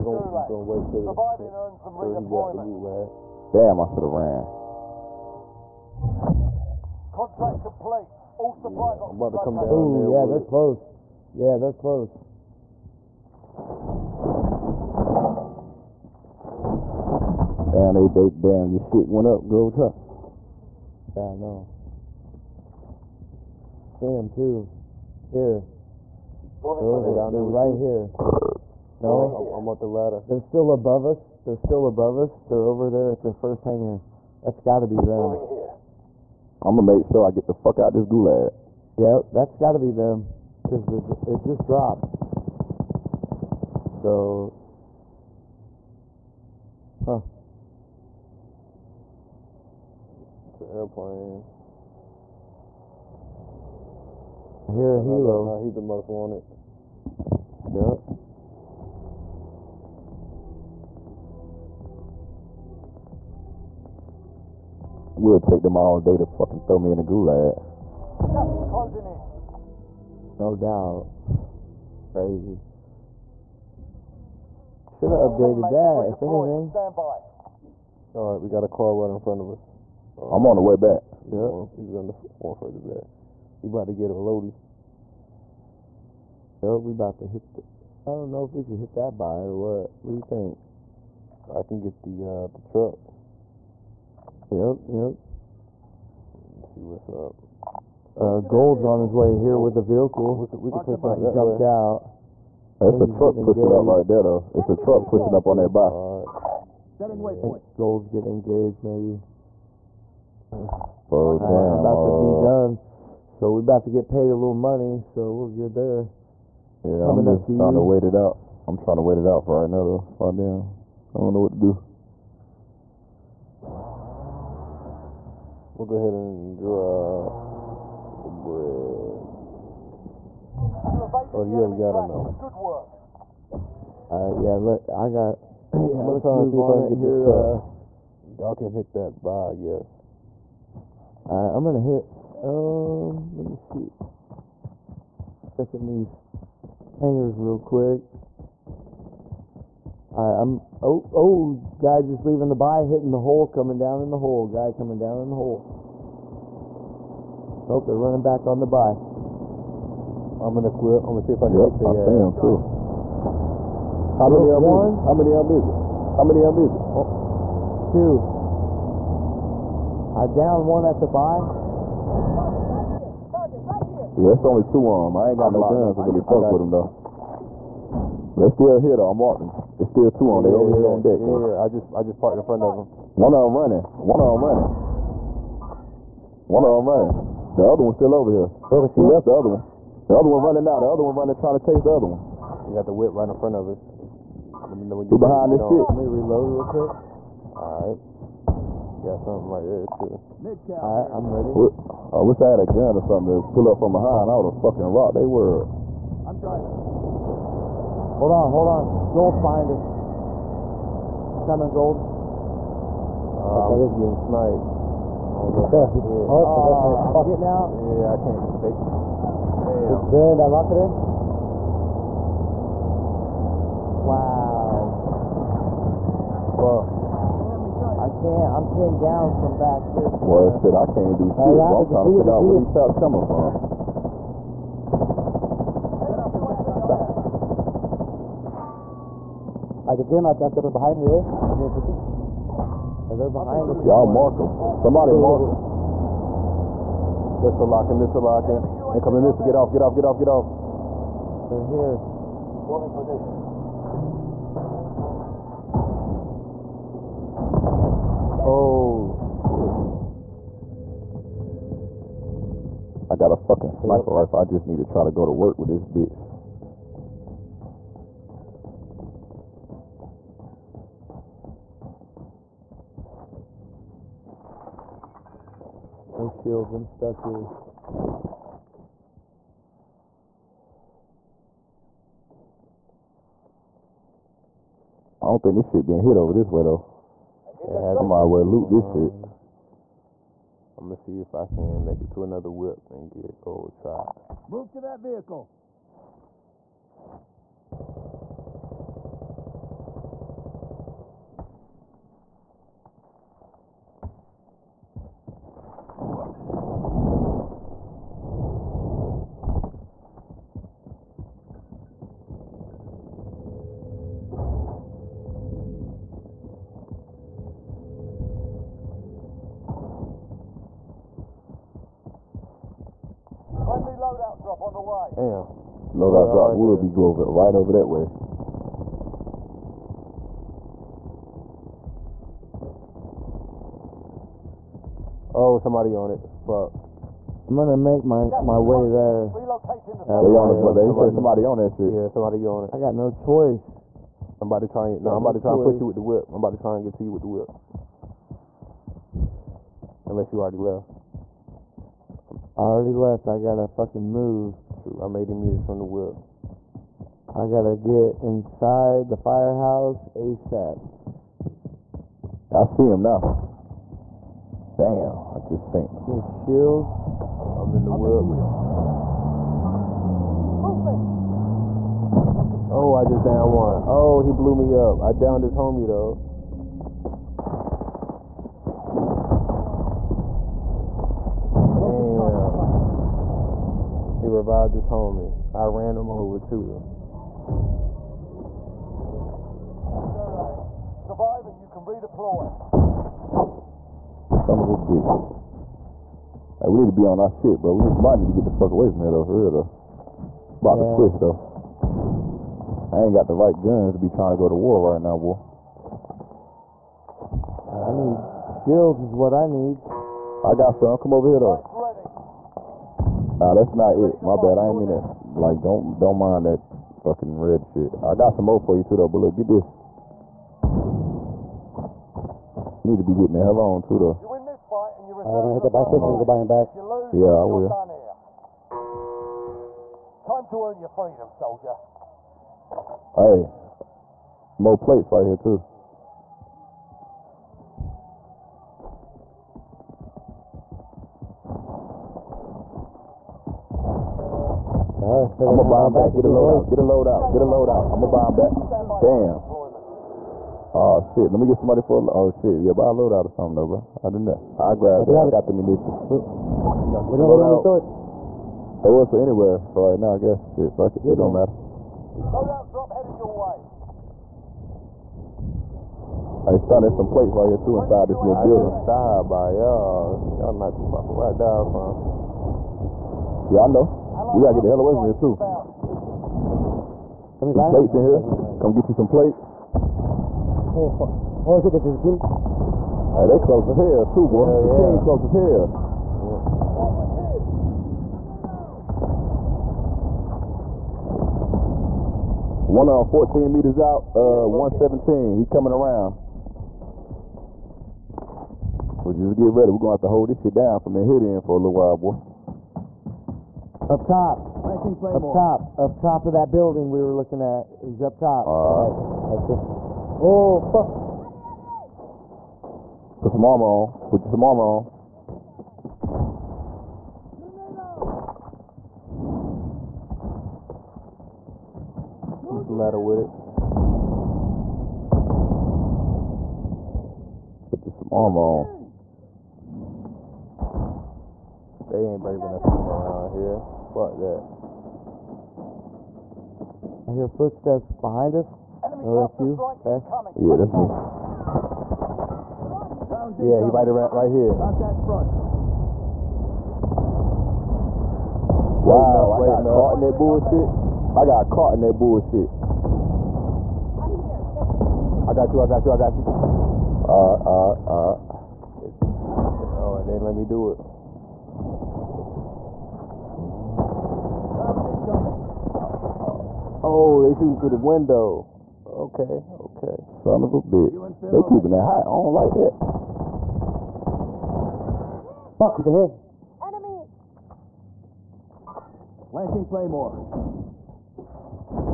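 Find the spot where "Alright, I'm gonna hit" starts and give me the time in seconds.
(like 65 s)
141 s.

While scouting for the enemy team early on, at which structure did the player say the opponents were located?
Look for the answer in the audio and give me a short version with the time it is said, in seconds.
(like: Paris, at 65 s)
first hangar, at 33 s.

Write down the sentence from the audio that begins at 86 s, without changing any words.
Yo, we about to hit the...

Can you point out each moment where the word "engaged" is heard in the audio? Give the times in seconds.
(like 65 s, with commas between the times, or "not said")
103 s, 108 s.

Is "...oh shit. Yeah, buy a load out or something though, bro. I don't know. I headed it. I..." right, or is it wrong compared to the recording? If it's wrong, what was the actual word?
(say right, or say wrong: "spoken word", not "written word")
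wrong: "grabbed", not "headed".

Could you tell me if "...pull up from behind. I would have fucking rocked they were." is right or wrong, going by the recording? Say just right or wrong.
right.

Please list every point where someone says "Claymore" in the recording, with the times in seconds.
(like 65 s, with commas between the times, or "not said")
504 s, 579 s.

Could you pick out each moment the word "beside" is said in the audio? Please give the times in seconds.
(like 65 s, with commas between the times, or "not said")
not said.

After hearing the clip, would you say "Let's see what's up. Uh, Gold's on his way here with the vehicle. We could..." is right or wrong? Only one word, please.
right.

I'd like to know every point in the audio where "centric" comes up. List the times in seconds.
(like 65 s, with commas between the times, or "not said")
not said.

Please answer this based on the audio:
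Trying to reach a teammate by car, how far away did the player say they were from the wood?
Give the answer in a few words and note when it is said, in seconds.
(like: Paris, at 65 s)
80 meters, at 355 s.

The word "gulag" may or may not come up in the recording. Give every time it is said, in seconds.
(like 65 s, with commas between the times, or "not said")
38 s, 67 s.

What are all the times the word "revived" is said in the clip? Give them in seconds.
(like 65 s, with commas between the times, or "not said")
384 s.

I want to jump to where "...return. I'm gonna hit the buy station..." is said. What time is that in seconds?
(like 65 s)
425 s.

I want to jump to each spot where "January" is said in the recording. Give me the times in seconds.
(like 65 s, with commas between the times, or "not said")
not said.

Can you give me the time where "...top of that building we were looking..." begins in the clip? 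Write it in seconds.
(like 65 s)
505 s.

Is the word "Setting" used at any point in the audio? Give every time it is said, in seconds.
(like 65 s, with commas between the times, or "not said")
106 s.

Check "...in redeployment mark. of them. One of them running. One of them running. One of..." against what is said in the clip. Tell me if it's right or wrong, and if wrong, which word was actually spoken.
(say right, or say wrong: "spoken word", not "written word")
wrong: "front", not "redeployment".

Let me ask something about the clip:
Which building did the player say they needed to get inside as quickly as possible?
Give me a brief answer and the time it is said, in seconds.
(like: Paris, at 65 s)
firehouse, at 359 s.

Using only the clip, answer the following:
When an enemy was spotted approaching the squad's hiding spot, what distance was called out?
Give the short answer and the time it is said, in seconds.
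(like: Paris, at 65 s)
14 meters, at 493 s.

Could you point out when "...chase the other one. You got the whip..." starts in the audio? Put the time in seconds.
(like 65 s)
191 s.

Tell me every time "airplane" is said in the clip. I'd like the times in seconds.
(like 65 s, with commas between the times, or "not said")
50 s.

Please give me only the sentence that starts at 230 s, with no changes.
Well, shit, I can't do shit.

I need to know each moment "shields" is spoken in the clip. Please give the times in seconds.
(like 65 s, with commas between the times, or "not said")
276 s, 366 s, 408 s.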